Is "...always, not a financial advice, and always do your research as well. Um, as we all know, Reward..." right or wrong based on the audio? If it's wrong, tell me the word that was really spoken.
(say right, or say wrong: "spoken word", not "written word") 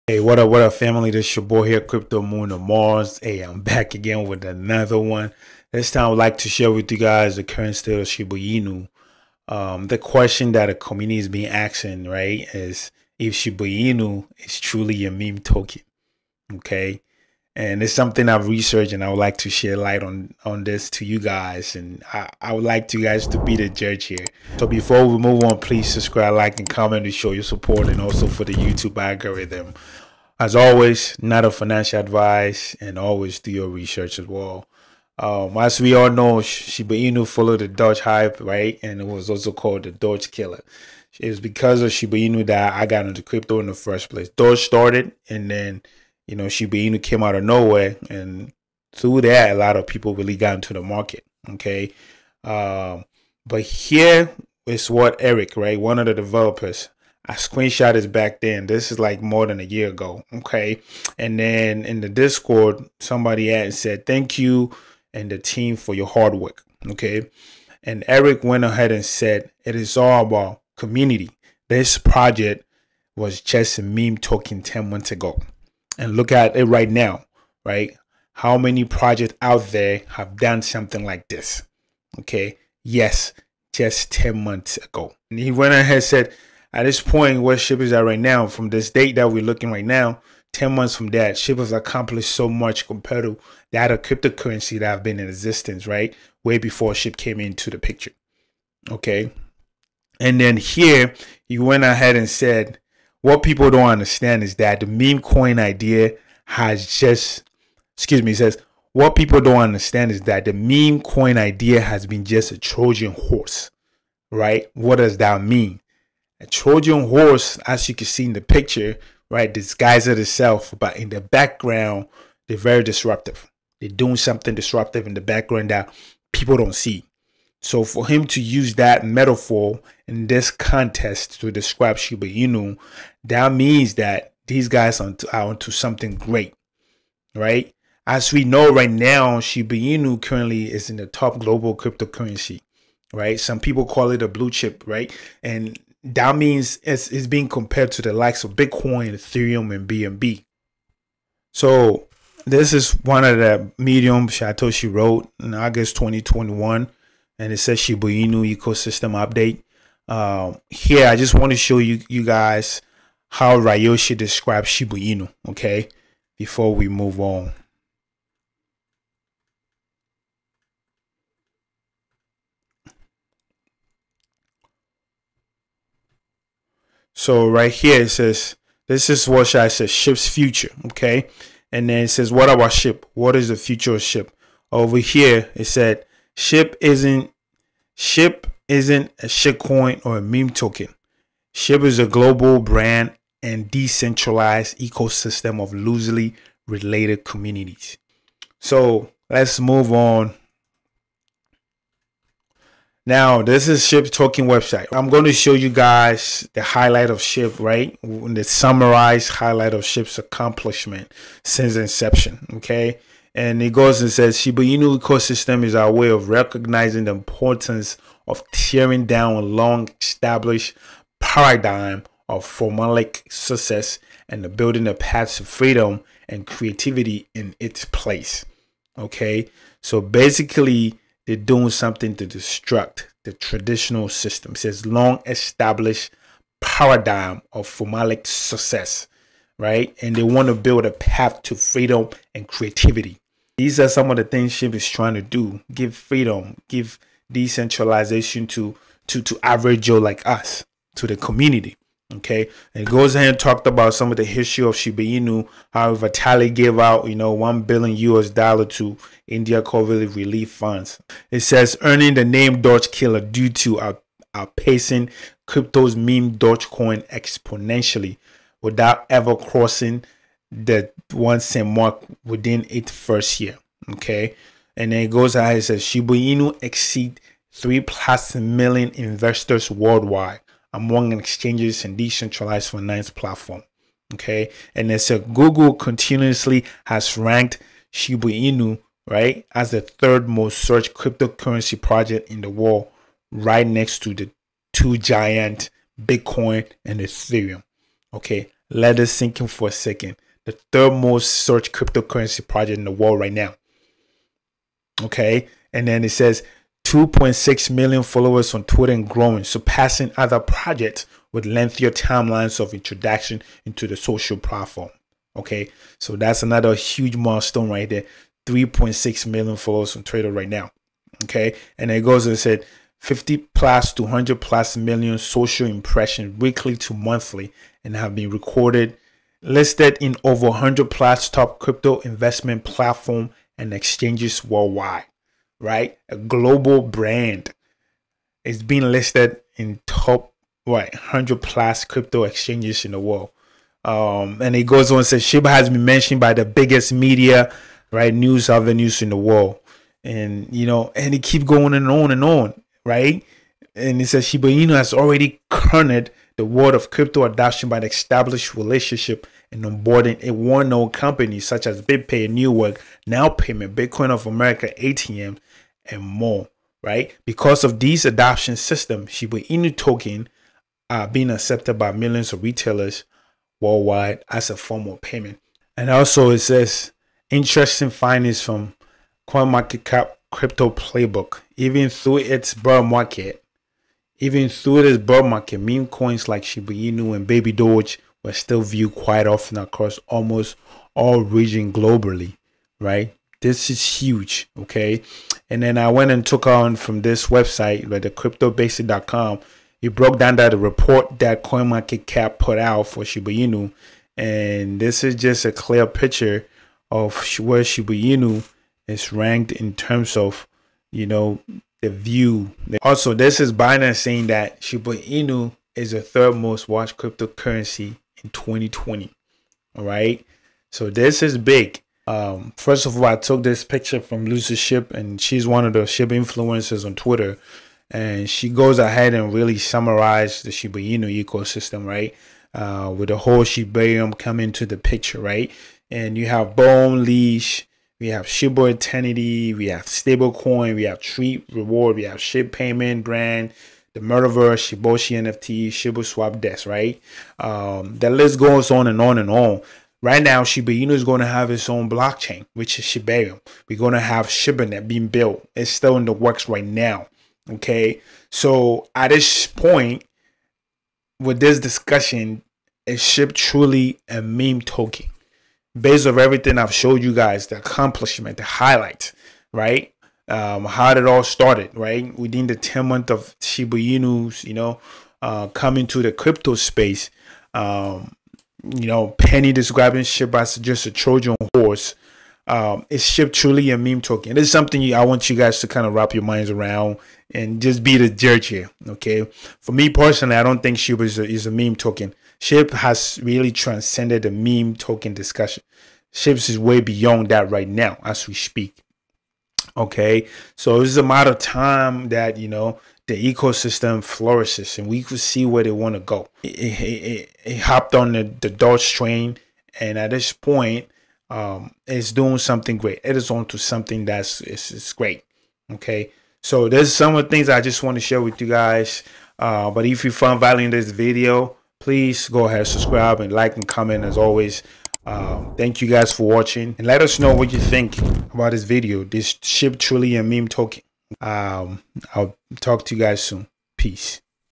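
wrong: "Shiba", not "Reward".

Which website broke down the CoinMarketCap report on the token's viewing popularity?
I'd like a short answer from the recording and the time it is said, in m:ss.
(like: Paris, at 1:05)
cryptobasic.com, at 6:38.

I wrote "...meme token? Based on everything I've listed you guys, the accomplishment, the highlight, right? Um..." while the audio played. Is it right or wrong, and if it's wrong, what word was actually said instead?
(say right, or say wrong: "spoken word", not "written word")
wrong: "showed", not "listed".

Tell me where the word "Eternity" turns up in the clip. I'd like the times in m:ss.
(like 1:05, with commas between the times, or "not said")
7:18.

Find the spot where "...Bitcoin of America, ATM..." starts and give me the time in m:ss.
6:03.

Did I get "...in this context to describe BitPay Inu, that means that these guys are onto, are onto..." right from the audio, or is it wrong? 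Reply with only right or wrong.
wrong.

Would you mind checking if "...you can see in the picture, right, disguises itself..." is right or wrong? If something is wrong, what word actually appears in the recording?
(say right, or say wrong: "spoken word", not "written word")
right.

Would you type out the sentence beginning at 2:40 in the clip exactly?
Uh, here, I just want to show you you guys how Ryoshi describes Shiba Inu.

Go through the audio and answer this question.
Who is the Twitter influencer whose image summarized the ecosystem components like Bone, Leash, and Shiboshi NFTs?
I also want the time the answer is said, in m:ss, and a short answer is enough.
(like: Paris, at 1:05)
Lucy SHIB, at 7:04.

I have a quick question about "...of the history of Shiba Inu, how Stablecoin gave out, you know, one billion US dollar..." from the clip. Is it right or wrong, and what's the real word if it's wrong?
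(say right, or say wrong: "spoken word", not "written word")
wrong: "Vitalik", not "Stablecoin".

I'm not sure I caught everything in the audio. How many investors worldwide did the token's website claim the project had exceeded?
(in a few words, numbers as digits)
3+ million.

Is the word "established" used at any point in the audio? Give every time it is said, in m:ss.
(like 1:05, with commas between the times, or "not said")
3:40, 3:55, 5:57.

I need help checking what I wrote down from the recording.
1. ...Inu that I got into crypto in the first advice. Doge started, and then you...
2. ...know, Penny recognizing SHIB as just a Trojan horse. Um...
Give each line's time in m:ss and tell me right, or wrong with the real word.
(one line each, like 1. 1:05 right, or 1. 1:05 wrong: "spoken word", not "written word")
1. 0:42 wrong: "place", not "advice"
2. 7:58 wrong: "describing", not "recognizing".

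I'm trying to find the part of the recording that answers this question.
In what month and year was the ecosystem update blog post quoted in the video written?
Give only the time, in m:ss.
2:35.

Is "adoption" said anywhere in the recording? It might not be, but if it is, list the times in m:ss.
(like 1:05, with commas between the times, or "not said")
5:57, 6:08.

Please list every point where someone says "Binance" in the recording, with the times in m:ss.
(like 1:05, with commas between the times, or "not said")
6:53.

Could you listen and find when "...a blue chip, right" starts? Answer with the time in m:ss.
2:24.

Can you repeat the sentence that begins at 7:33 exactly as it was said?
We're going to have ShibaNet being built.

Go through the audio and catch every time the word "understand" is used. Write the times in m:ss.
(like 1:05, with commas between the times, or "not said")
1:43, 1:49.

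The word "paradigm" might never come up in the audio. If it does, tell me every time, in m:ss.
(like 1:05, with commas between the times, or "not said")
3:41, 3:56.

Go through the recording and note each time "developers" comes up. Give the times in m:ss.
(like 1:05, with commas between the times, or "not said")
0:56.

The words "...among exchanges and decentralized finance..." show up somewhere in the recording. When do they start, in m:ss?
4:40.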